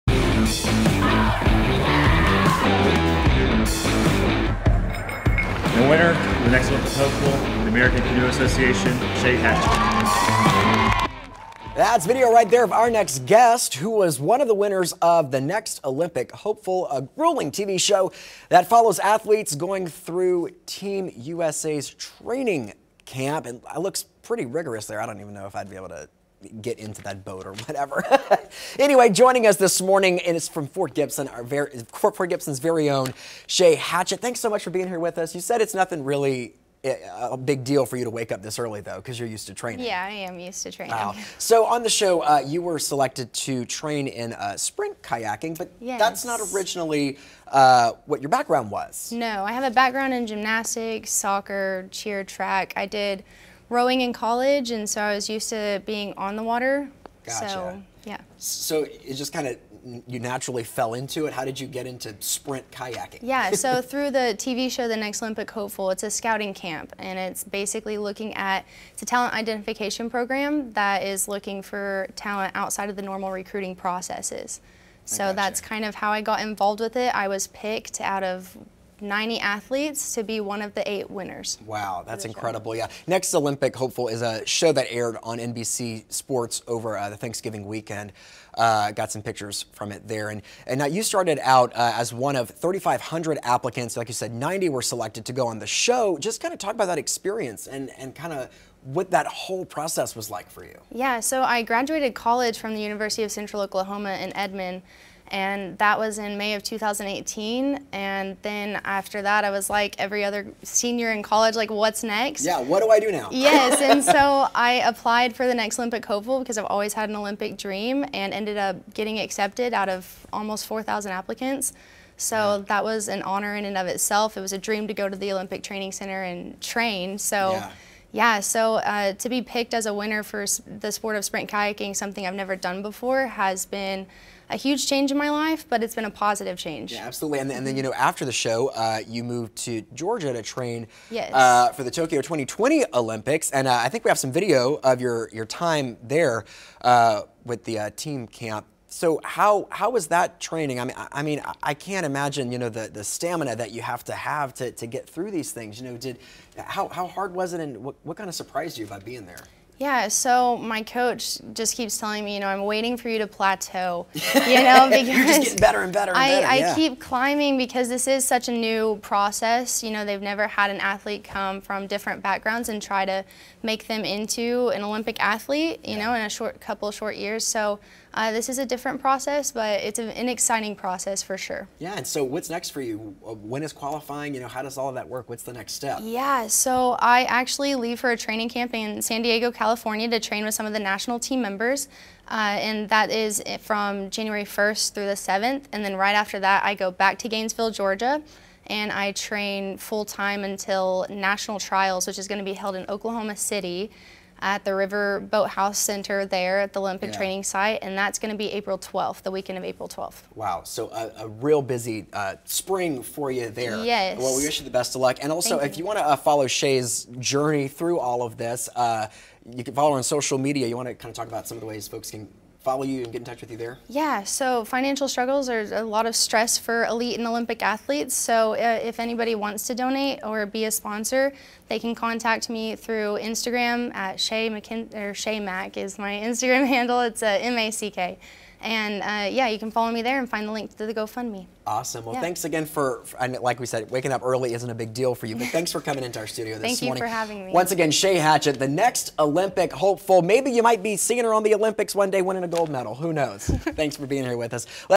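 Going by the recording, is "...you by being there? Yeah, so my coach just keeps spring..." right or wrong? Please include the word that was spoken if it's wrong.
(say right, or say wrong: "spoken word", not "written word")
wrong: "telling", not "spring".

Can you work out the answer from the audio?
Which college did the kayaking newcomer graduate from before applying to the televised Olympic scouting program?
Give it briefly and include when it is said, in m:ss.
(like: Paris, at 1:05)
University of Central Oklahoma, at 1:42.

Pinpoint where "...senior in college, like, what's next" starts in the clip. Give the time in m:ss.
1:50.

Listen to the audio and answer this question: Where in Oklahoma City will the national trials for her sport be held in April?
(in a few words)
River Boathouse Center.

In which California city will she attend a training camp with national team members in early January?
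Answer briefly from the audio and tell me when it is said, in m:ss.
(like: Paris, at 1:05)
San Diego, at 3:09.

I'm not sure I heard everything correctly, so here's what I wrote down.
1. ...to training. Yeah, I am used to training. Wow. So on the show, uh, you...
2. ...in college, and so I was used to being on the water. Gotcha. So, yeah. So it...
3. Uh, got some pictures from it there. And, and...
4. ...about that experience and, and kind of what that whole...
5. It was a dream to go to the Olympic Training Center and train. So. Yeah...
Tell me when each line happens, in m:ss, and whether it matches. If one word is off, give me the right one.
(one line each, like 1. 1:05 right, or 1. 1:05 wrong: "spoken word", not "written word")
1. 0:39 right
2. 0:54 right
3. 1:28 right
4. 1:36 right
5. 2:04 right.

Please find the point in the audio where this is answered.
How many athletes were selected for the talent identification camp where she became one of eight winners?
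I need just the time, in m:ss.
1:19.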